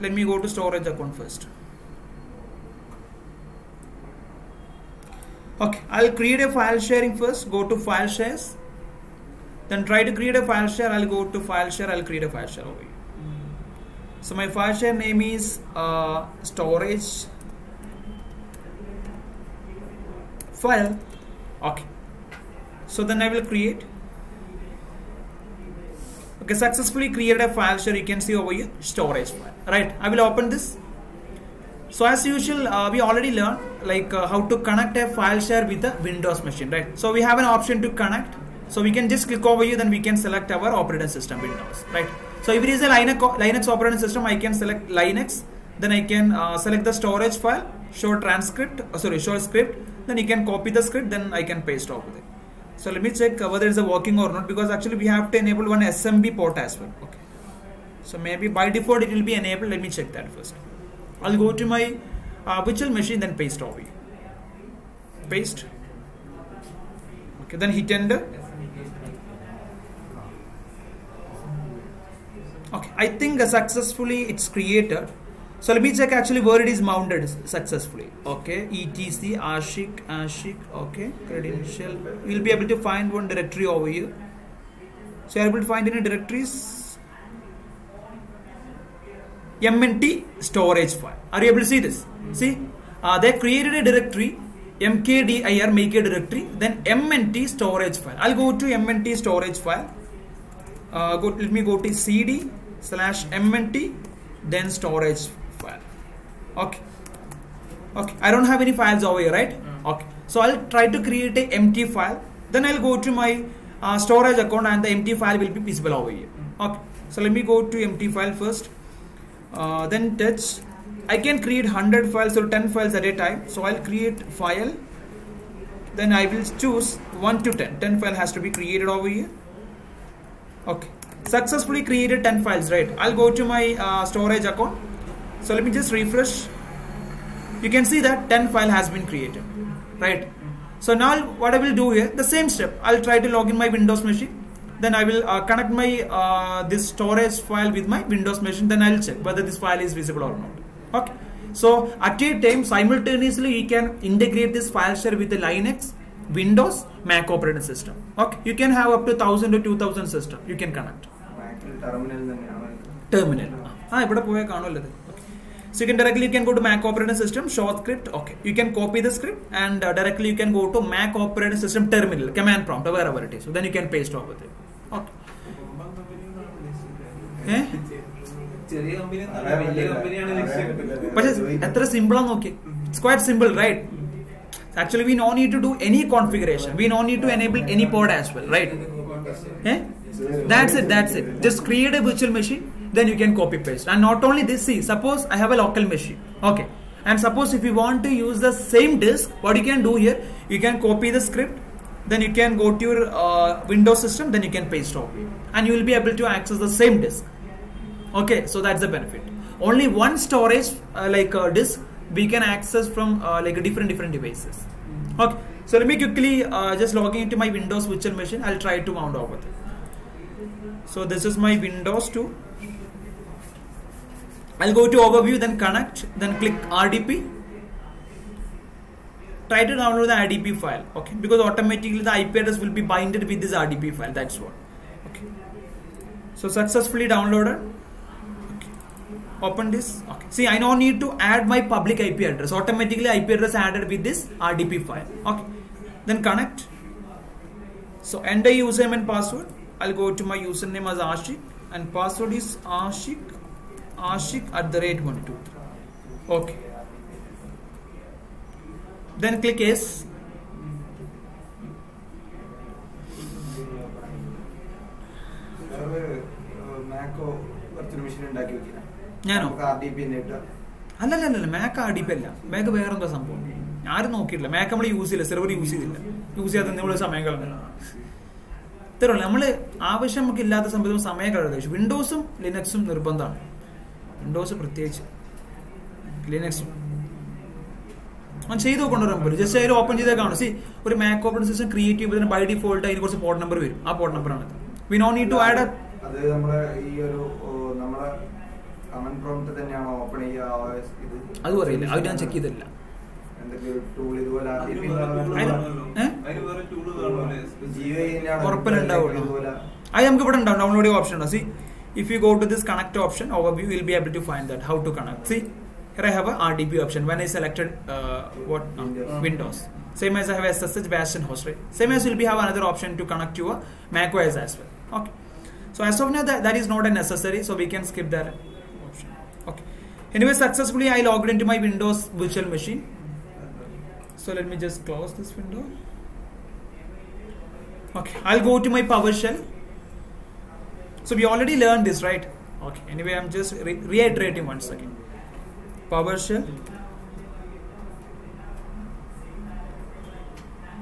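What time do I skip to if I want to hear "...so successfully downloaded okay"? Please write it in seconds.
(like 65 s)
236 s.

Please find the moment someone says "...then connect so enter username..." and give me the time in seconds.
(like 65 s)
246 s.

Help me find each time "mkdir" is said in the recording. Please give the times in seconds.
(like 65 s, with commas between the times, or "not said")
94 s.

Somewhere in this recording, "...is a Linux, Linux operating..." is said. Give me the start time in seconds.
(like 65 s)
42 s.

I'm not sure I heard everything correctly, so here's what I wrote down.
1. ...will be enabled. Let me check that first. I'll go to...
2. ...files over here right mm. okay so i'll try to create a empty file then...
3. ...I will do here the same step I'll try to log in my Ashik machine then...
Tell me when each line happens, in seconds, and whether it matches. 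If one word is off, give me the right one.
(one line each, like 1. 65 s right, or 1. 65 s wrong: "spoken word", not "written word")
1. 59 s right
2. 108 s right
3. 141 s wrong: "Windows", not "Ashik".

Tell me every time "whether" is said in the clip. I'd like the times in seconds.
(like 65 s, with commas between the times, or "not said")
53 s, 149 s.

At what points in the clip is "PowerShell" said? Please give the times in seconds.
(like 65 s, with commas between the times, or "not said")
338 s, 345 s.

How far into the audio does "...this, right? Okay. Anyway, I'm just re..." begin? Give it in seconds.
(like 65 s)
341 s.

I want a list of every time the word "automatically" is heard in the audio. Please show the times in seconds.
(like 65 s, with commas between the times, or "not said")
231 s, 242 s.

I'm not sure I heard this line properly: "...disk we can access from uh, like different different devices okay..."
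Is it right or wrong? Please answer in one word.
right.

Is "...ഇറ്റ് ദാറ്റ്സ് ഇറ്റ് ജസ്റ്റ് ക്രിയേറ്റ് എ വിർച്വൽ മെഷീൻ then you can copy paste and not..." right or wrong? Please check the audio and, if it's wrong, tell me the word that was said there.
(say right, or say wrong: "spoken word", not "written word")
right.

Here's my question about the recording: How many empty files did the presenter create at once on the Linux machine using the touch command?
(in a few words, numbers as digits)
10.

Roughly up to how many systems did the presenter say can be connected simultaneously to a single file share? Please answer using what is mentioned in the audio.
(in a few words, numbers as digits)
1000 to 2000.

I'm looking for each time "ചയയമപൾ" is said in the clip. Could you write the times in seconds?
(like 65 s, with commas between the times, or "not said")
292 s.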